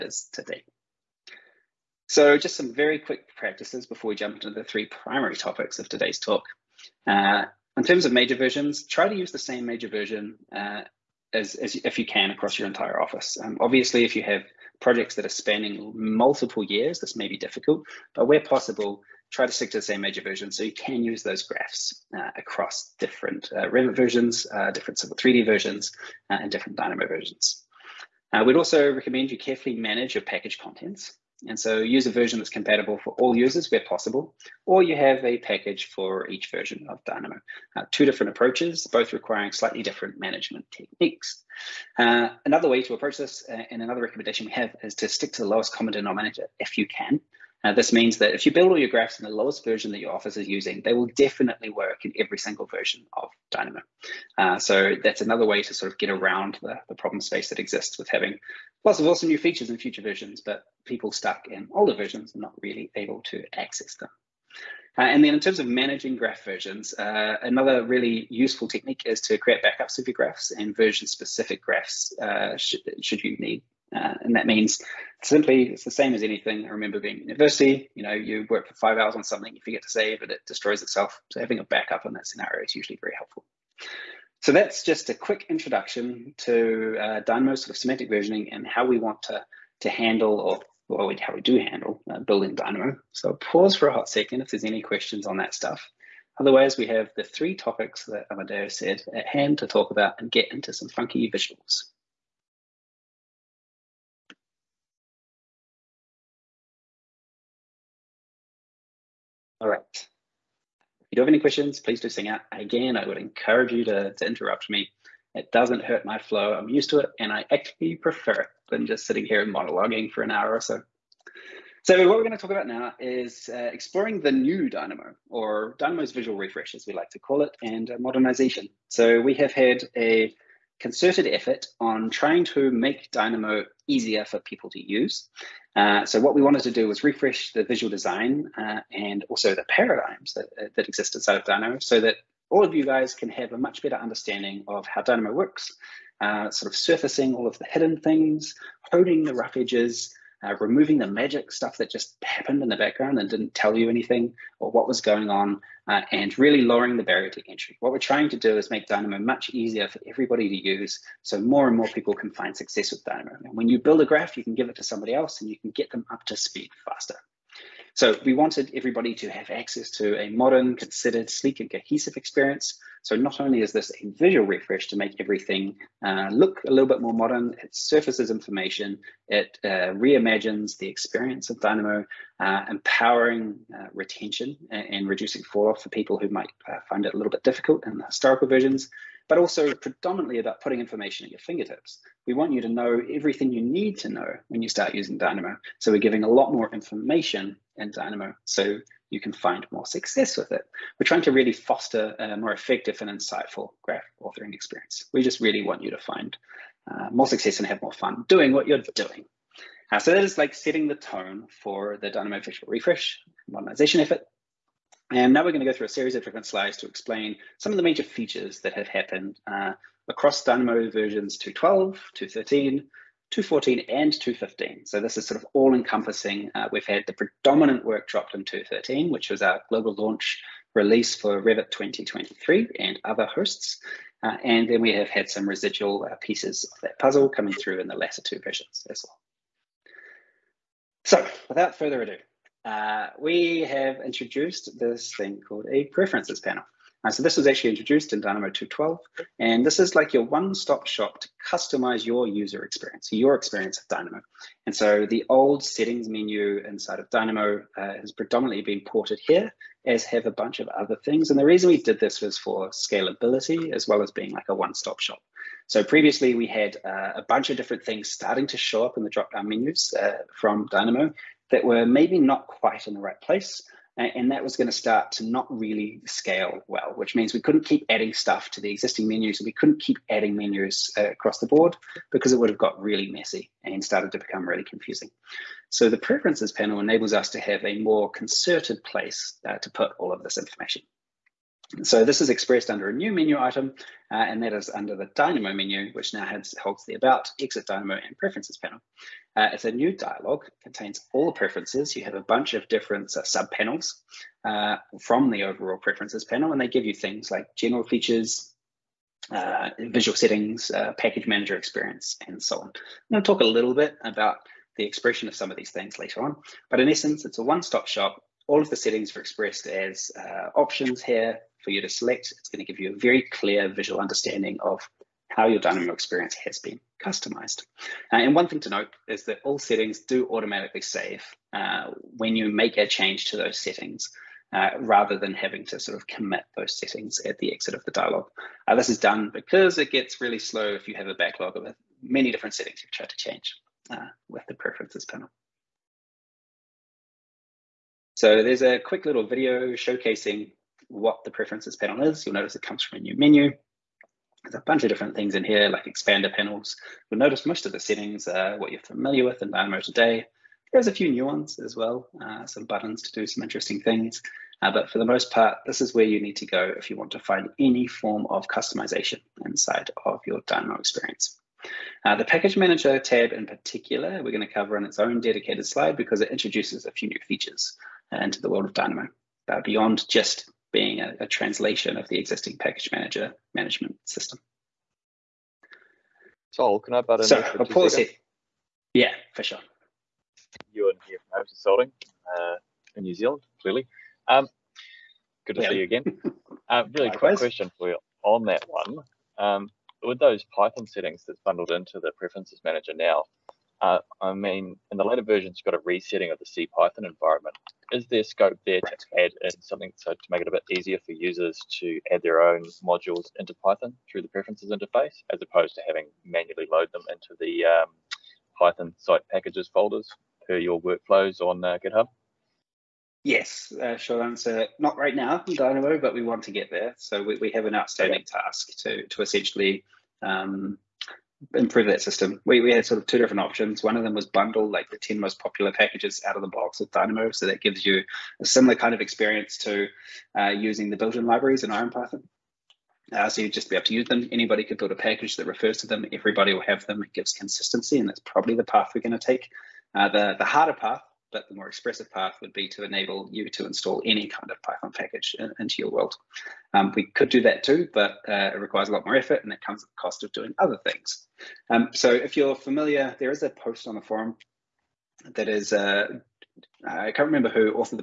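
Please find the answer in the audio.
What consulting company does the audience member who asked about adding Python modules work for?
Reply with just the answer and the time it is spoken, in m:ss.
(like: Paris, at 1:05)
Hope Consulting, at 6:31.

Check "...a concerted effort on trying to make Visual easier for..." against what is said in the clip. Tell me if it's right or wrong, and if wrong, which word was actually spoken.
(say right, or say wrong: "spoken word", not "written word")
wrong: "Dynamo", not "Visual".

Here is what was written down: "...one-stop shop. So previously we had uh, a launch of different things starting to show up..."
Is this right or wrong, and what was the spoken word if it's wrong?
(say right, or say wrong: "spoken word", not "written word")
wrong: "bunch", not "launch".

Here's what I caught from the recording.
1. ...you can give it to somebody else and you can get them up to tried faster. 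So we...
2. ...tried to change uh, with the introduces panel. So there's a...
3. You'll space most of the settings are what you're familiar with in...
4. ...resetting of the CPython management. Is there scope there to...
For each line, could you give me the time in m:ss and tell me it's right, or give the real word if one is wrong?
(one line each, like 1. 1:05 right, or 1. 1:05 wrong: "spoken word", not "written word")
1. 2:44 wrong: "speed", not "tried"
2. 5:42 wrong: "preferences", not "introduces"
3. 5:57 wrong: "notice", not "space"
4. 6:45 wrong: "environment", not "management".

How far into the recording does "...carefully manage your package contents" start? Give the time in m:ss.
0:29.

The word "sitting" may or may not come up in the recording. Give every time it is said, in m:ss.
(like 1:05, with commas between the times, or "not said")
1:59.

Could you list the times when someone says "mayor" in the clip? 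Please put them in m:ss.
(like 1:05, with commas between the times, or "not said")
not said.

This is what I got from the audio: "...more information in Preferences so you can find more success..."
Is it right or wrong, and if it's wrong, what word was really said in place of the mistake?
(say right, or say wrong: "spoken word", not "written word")
wrong: "Dynamo", not "Preferences".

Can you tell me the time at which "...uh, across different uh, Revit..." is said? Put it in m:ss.
0:22.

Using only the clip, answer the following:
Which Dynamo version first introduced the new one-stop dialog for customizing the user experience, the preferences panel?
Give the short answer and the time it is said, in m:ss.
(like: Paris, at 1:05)
2.12, at 4:08.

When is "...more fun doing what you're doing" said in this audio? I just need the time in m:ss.
3:27.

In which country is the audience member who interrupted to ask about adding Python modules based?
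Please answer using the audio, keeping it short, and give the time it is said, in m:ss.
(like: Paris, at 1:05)
New Zealand, at 6:33.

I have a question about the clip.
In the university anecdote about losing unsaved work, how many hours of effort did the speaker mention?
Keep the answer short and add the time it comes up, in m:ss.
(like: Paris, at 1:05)
5, at 1:18.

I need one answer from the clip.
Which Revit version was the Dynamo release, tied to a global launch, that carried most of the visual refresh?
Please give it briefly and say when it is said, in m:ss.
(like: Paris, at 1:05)
Revit 2023, at 3:51.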